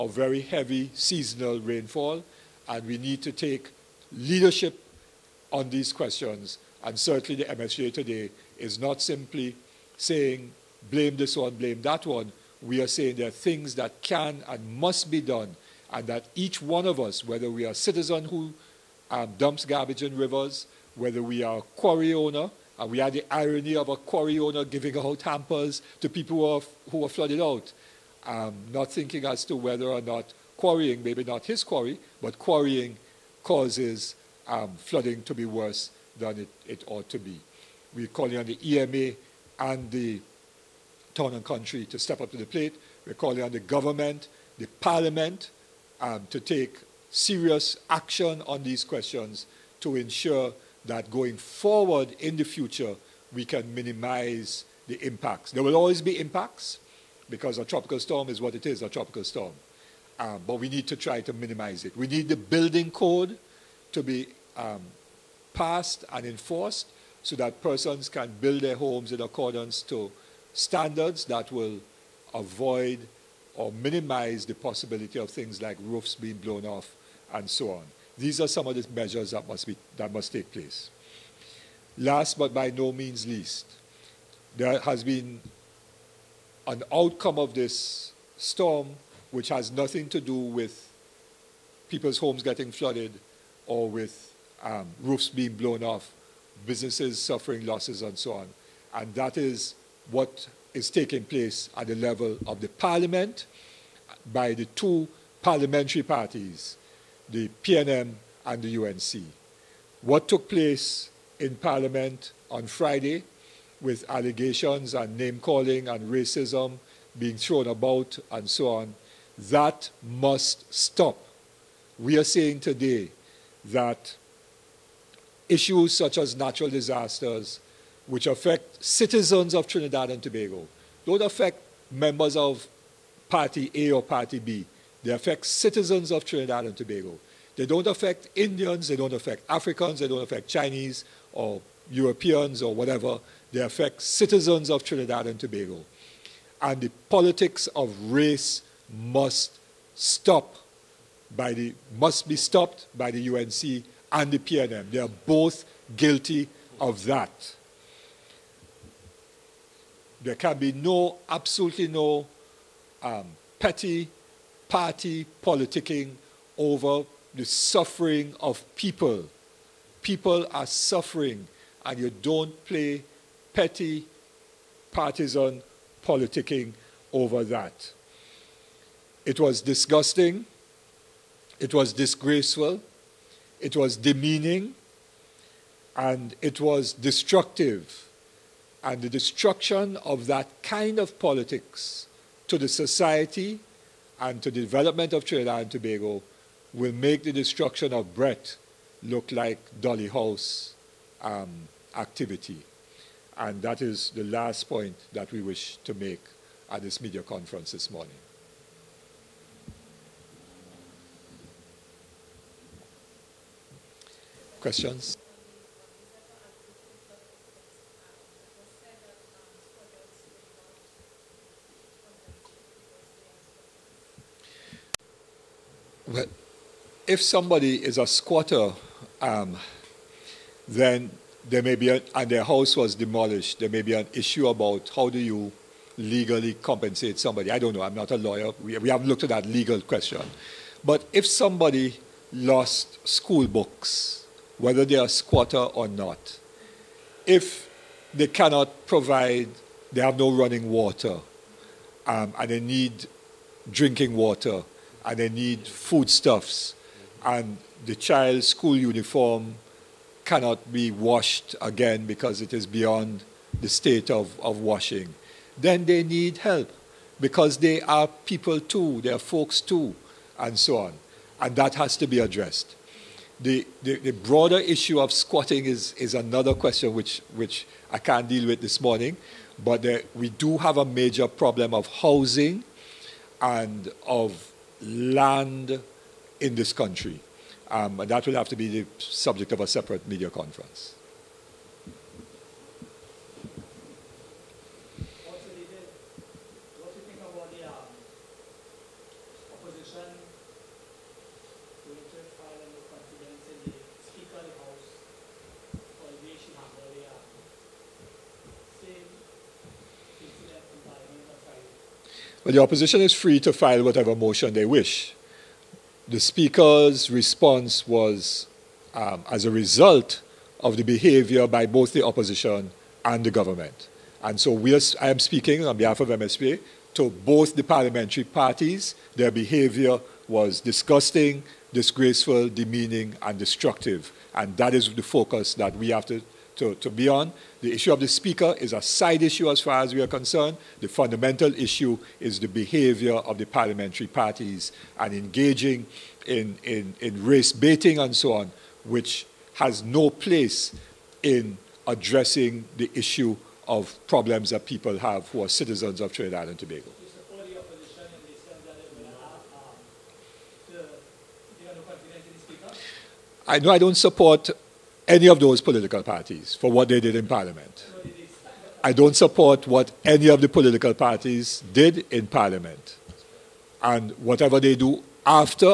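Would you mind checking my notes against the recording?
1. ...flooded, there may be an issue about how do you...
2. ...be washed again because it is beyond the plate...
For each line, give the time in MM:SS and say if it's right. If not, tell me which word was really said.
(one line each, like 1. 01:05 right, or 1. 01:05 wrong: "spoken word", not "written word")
1. 03:52 wrong: "demolished", not "flooded"
2. 04:20 wrong: "state", not "plate".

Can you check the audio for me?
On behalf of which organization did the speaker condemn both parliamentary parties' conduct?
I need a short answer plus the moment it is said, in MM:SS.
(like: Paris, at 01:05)
MSJ, at 05:26.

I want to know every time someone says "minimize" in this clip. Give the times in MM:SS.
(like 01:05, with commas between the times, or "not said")
00:53, 01:01, 01:13.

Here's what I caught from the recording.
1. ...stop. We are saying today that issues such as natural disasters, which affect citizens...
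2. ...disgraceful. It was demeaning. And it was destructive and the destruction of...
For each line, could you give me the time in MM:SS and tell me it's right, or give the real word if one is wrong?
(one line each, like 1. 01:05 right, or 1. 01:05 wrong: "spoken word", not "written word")
1. 02:00 right
2. 03:01 right.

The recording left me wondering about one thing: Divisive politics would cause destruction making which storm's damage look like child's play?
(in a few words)
Bret.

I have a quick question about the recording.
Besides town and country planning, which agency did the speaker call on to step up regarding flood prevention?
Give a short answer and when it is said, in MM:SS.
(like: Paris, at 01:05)
EMA, at 00:38.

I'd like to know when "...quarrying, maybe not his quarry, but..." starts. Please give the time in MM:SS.
00:30.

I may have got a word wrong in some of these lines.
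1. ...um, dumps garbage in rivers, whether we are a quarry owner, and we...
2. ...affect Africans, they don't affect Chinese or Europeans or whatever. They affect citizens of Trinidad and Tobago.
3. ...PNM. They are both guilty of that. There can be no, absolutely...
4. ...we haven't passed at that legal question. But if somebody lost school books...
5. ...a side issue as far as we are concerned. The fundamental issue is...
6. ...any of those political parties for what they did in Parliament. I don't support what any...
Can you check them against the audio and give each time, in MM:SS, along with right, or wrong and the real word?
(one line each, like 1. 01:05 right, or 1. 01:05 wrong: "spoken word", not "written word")
1. 00:19 right
2. 02:19 right
3. 02:34 right
4. 03:58 wrong: "looked", not "passed"
5. 05:38 right
6. 06:05 right.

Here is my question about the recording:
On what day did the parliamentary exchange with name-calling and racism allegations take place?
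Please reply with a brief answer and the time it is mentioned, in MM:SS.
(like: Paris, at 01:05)
Friday, at 01:52.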